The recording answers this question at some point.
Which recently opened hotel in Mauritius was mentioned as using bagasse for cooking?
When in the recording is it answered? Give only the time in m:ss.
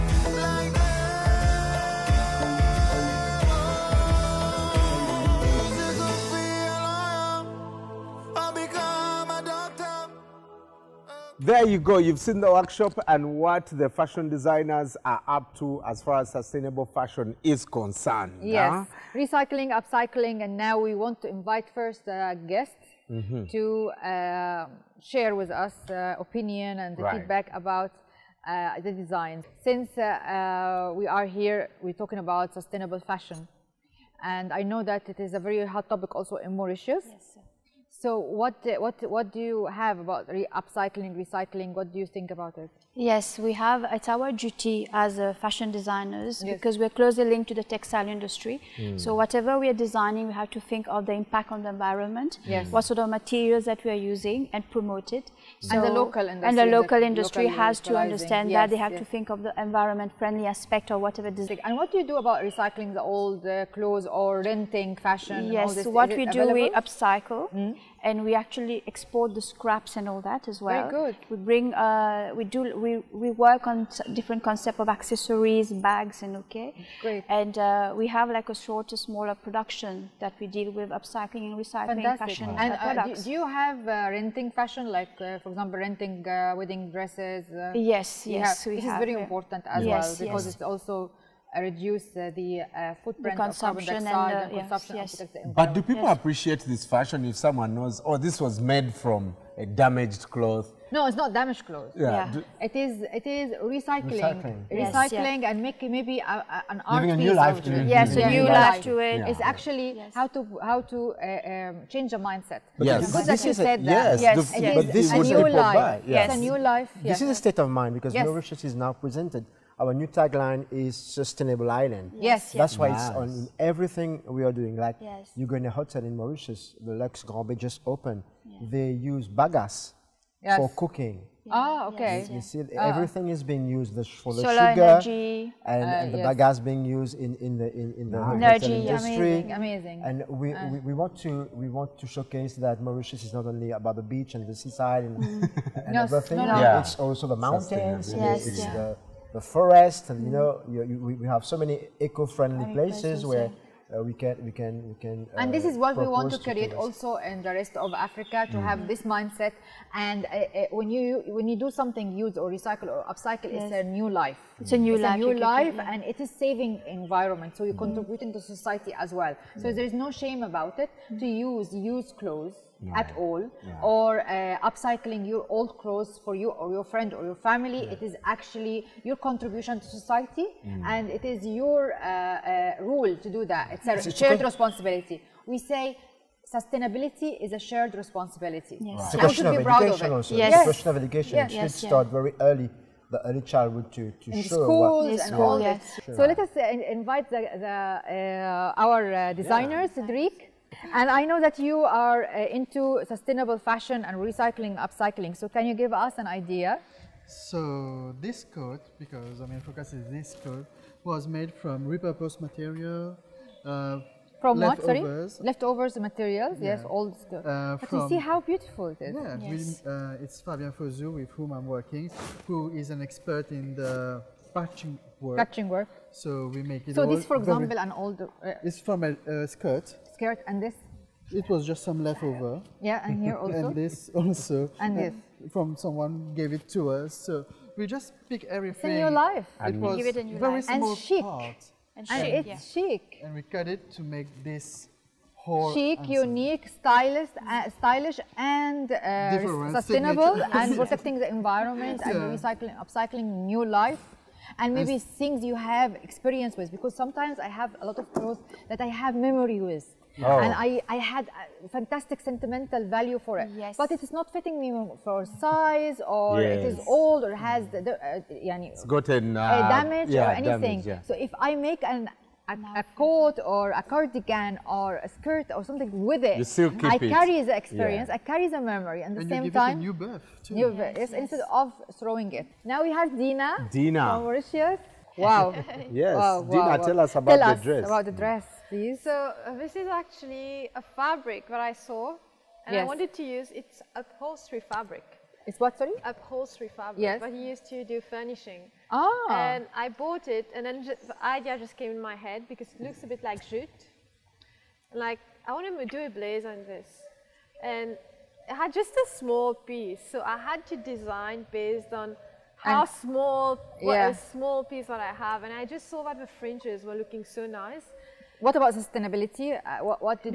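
2:06.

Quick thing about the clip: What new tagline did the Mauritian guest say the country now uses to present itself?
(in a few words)
Sustainable island.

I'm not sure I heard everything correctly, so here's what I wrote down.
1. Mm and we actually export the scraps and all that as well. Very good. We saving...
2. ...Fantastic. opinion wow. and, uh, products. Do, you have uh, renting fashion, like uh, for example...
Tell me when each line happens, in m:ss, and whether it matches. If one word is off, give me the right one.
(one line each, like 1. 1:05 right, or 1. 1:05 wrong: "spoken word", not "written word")
1. 1:07 wrong: "bring", not "saving"
2. 1:22 wrong: "fashion", not "opinion".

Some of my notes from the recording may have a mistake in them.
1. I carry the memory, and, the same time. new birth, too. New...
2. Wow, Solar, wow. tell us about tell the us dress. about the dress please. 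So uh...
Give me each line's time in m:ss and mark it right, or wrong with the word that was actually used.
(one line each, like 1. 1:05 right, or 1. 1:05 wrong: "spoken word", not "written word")
1. 4:38 right
2. 4:46 wrong: "Dina", not "Solar".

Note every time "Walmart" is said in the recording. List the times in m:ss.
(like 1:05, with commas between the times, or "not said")
not said.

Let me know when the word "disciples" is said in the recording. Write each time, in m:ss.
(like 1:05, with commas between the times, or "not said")
not said.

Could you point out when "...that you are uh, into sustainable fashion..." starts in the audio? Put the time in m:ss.
3:21.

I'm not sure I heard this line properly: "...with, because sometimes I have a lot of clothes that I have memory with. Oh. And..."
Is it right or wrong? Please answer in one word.
right.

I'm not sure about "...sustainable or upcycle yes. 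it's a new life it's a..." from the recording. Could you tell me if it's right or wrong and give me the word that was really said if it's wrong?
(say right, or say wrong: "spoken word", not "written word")
wrong: "recycle", not "sustainable".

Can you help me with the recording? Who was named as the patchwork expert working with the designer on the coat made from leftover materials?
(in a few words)
Fabian Fozu.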